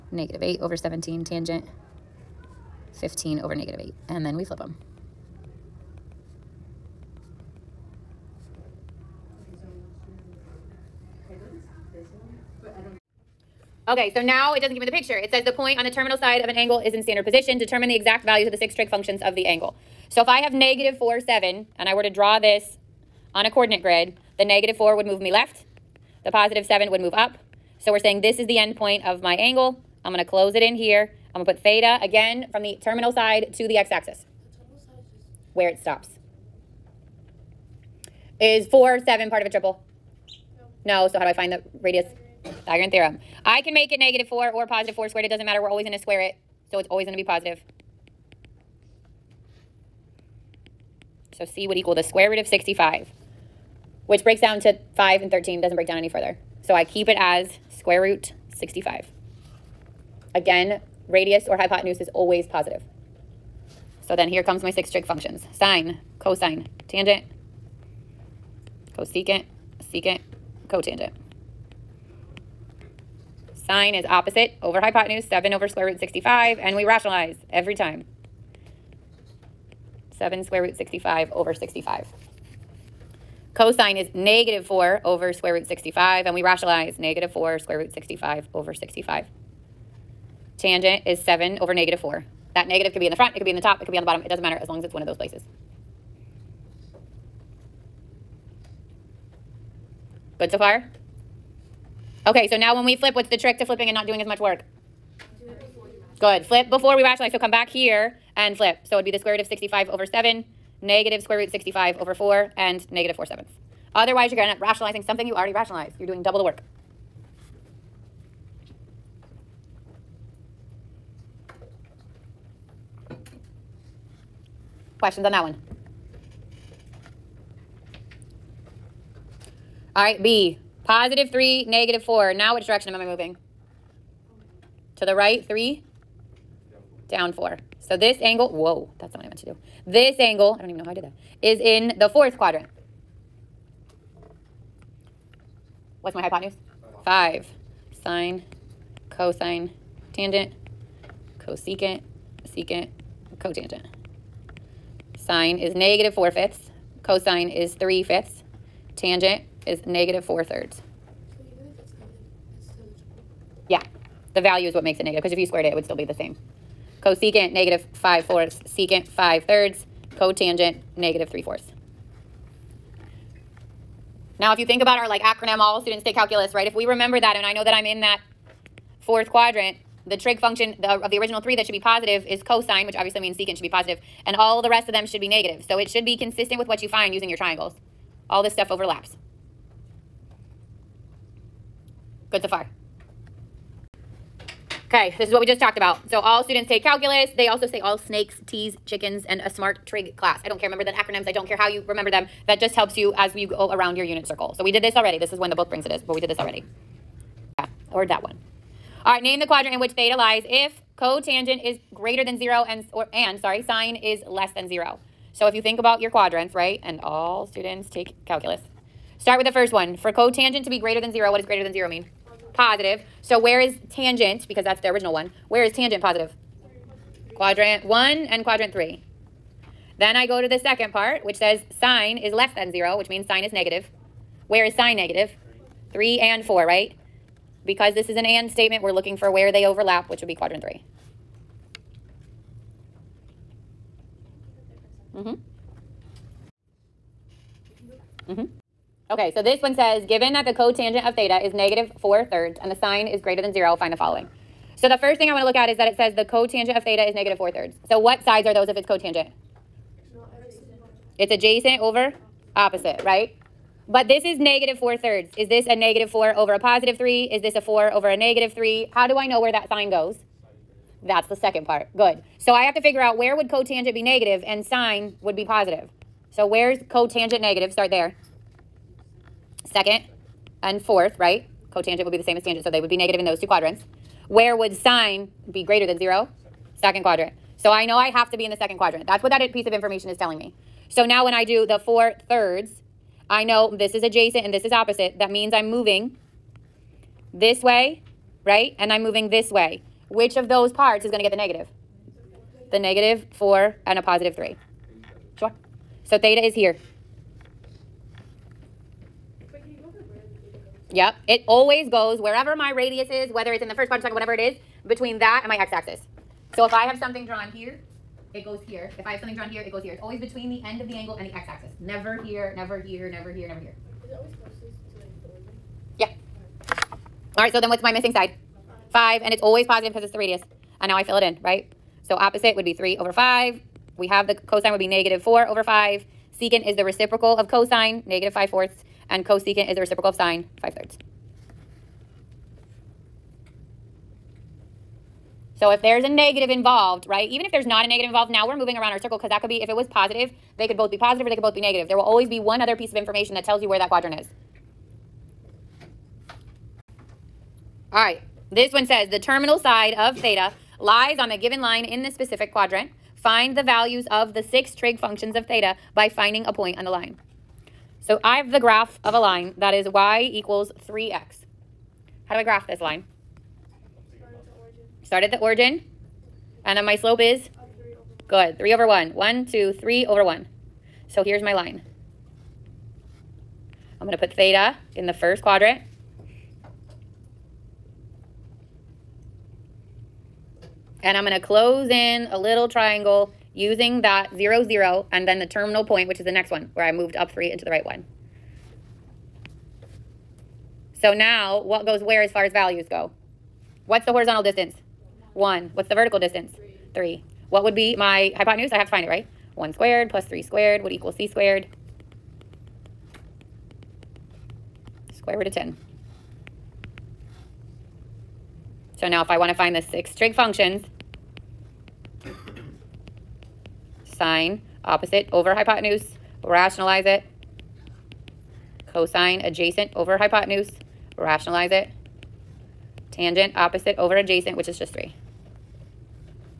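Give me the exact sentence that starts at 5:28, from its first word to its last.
Five, and it's always positive because it's the radius.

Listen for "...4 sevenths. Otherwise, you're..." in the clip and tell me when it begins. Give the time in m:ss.
1:53.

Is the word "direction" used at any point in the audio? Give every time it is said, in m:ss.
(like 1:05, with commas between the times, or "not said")
2:12.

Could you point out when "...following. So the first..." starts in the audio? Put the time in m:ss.
4:13.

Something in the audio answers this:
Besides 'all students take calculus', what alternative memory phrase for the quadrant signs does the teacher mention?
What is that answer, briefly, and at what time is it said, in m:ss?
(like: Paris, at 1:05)
all snakes, teas, chickens, at 3:17.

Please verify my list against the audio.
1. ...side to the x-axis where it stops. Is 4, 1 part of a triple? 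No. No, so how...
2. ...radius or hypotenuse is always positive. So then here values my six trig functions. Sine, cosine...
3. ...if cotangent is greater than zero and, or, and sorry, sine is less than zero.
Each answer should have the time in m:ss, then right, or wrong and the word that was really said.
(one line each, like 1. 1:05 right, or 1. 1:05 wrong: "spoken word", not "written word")
1. 0:33 wrong: "7", not "1"
2. 1:01 wrong: "comes", not "values"
3. 3:30 right.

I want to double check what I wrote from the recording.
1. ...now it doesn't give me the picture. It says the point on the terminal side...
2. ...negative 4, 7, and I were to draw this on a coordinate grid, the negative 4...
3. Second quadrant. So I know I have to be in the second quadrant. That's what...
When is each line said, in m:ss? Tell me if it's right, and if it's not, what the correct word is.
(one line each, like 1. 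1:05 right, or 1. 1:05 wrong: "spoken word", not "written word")
1. 0:14 right
2. 0:20 right
3. 4:46 right.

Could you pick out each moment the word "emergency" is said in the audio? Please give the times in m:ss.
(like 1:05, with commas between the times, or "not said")
not said.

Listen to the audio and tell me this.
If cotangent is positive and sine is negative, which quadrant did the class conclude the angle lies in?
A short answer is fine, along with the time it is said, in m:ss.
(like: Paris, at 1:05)
quadrant 3, at 4:00.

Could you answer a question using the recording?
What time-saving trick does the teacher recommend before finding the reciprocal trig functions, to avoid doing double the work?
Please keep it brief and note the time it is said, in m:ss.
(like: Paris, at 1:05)
Flip before we rationalize, at 1:46.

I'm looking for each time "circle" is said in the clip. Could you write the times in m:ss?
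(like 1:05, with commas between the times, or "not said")
3:24, 5:48.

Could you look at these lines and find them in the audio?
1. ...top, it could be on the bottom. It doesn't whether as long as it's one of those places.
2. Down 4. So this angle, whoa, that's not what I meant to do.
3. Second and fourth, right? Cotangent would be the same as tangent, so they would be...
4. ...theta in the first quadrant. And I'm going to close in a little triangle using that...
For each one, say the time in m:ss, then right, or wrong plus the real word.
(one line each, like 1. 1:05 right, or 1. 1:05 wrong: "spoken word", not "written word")
1. 1:33 wrong: "matter", not "whether"
2. 2:17 right
3. 4:39 right
4. 6:24 right.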